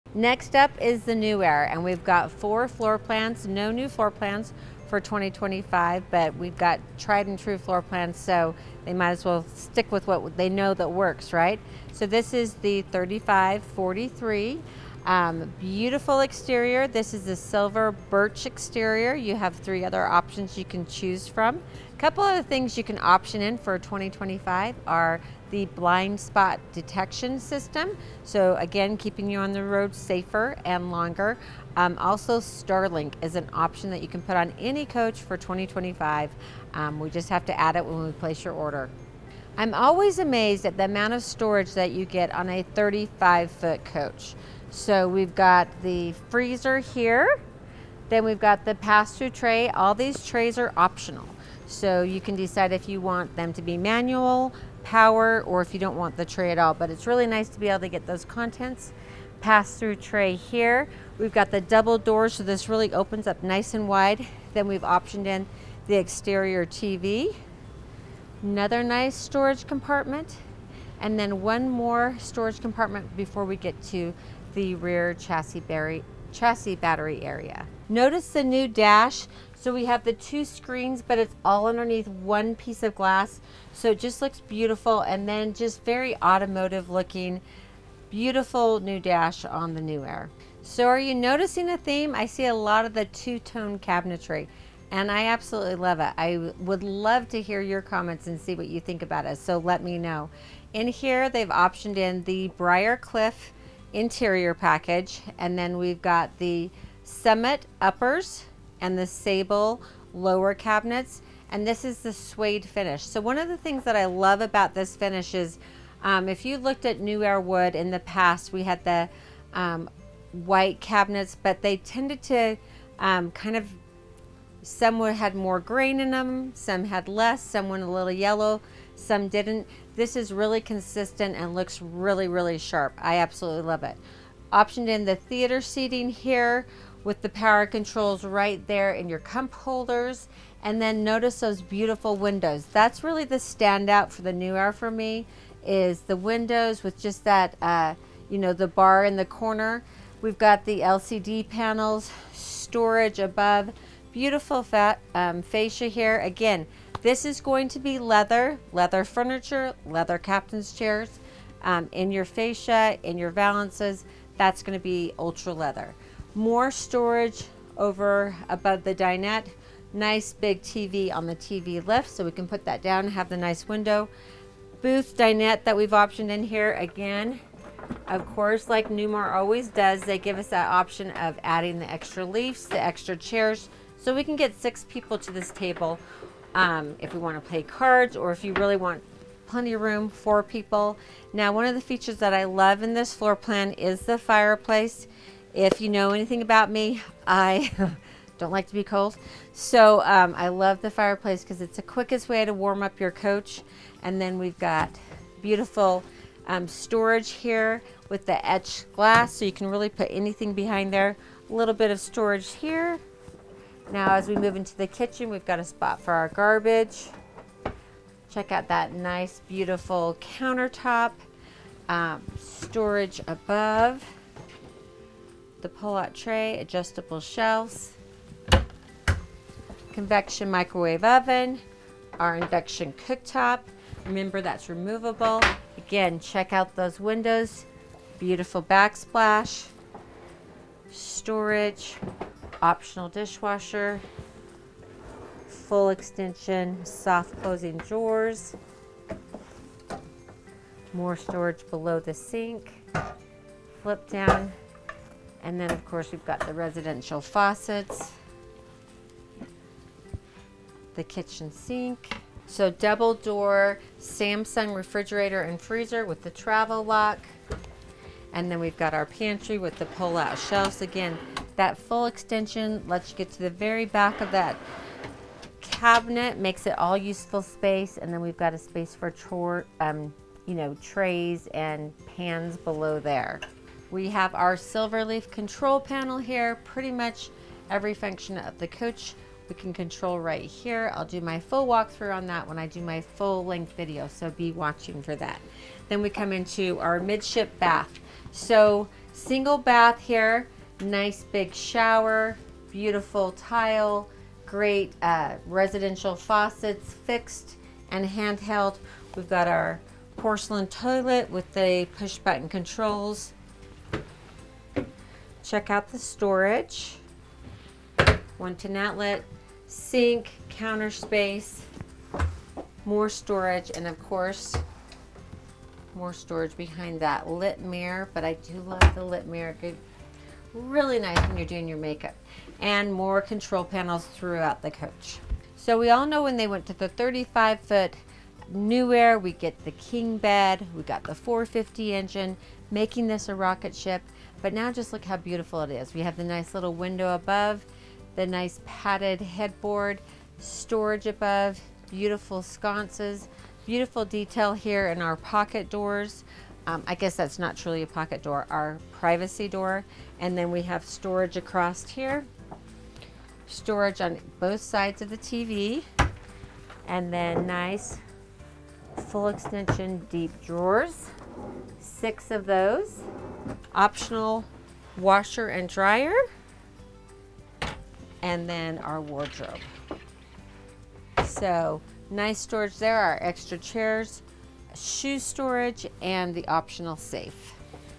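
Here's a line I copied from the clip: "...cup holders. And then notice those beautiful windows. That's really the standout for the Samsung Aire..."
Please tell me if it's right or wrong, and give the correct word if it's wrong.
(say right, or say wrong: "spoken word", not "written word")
wrong: "New", not "Samsung".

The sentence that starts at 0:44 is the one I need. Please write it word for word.
So we've got the freezer here, then we've got the pass-through tray.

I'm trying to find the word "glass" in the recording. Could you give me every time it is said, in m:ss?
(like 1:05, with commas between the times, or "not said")
1:22, 3:28.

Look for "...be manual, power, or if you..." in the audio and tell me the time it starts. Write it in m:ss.
0:53.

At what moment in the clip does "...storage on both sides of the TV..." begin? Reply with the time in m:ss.
6:03.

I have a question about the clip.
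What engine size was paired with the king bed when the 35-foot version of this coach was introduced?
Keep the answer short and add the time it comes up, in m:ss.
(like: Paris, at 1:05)
450, at 5:41.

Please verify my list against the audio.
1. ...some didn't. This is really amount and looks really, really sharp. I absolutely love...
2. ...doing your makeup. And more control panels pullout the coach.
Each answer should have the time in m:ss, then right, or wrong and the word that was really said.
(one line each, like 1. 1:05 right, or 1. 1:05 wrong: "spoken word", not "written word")
1. 2:08 wrong: "consistent", not "amount"
2. 5:31 wrong: "throughout", not "pullout".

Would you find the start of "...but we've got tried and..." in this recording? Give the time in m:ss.
0:06.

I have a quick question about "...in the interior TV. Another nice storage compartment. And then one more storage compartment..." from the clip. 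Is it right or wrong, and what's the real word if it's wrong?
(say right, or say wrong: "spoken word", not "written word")
wrong: "exterior", not "interior".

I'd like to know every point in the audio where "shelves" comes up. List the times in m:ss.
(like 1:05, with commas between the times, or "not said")
3:47, 4:30.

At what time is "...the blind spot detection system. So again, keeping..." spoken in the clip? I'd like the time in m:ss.
0:25.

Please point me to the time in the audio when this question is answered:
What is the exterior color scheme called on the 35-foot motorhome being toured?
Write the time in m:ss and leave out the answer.
0:17.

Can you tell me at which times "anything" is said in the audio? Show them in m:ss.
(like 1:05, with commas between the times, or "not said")
3:16, 3:30.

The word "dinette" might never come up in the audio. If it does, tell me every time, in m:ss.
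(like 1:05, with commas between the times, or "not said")
2:48, 2:55.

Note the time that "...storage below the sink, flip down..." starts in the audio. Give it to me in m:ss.
4:11.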